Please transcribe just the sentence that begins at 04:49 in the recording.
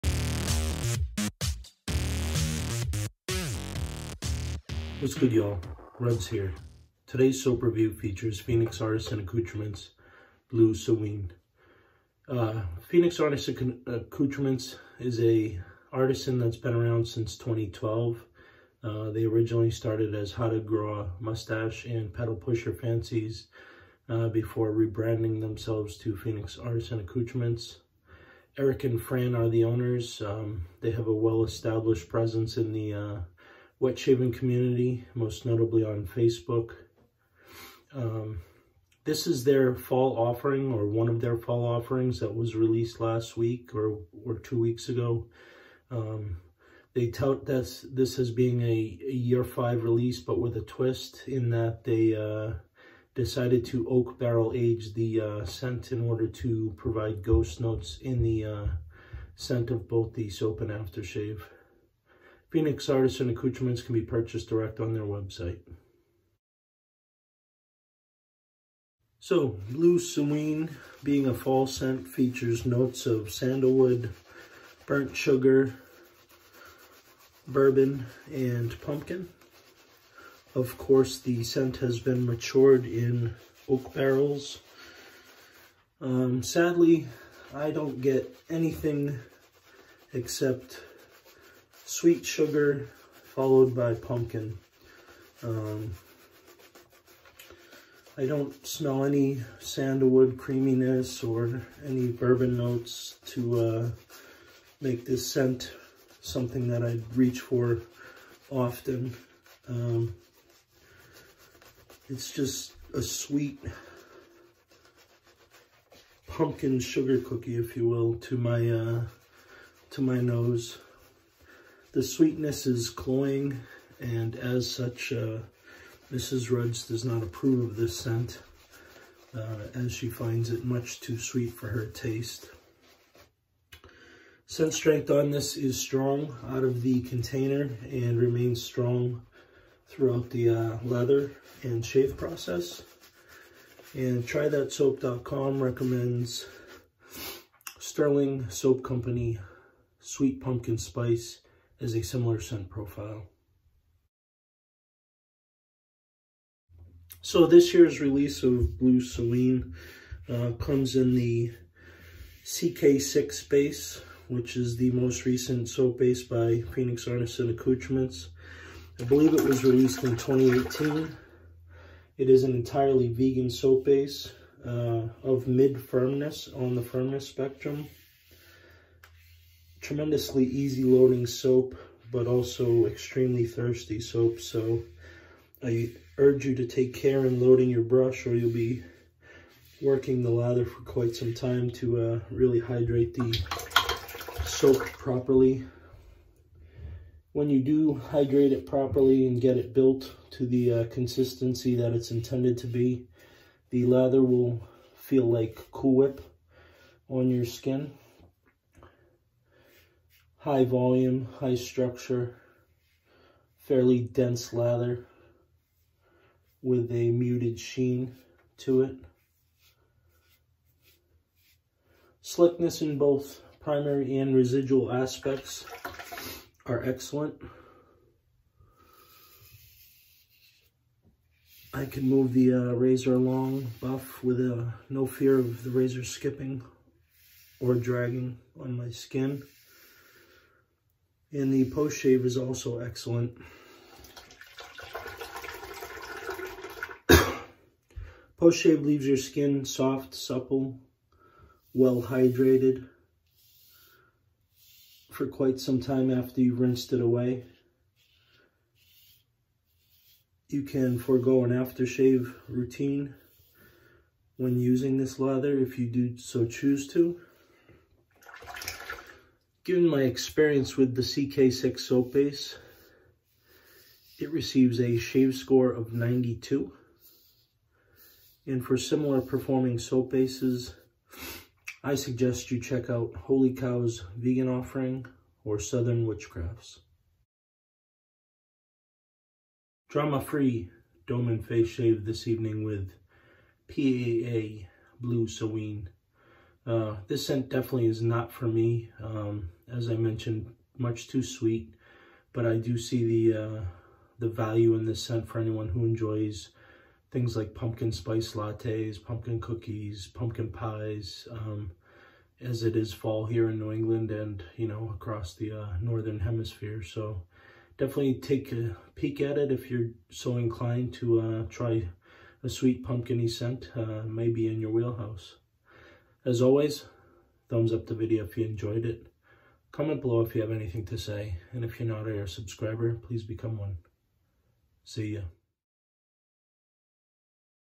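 Drama-free Dome and Face Shave this evening with PAA Blue Samhain.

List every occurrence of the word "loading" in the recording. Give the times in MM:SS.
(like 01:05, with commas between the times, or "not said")
03:00, 03:07.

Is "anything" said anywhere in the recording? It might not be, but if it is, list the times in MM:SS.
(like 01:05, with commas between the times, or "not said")
01:28, 05:30.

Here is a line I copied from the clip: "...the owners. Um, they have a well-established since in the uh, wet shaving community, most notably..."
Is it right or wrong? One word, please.
wrong.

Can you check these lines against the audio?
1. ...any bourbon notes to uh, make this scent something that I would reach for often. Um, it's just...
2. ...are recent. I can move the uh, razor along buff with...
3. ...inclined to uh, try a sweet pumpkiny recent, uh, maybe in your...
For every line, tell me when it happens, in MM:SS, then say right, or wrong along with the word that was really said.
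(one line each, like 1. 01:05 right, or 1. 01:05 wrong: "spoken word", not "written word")
1. 01:41 right
2. 03:46 wrong: "excellent", not "recent"
3. 05:20 wrong: "scent", not "recent".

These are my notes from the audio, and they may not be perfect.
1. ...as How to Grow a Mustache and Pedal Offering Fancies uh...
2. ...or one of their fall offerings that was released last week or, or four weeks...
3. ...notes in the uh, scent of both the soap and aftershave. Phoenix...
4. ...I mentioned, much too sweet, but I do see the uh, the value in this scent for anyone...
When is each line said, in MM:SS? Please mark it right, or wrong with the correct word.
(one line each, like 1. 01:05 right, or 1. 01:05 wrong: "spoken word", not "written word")
1. 00:20 wrong: "Pusher", not "Offering"
2. 00:40 wrong: "two", not "four"
3. 00:57 right
4. 04:59 right.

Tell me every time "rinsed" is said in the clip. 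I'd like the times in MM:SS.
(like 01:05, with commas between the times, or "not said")
04:16.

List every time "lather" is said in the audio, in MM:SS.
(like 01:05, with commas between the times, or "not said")
03:10, 03:23, 03:34, 04:25.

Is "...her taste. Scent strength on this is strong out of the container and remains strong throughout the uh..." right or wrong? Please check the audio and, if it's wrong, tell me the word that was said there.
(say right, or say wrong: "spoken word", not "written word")
right.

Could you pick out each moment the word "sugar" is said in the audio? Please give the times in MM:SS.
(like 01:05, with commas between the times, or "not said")
01:15, 01:32, 01:56.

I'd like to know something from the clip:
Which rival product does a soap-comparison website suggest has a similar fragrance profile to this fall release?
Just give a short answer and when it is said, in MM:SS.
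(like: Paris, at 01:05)
Sterling Soap Company Sweet Pumpkin Spice, at 02:27.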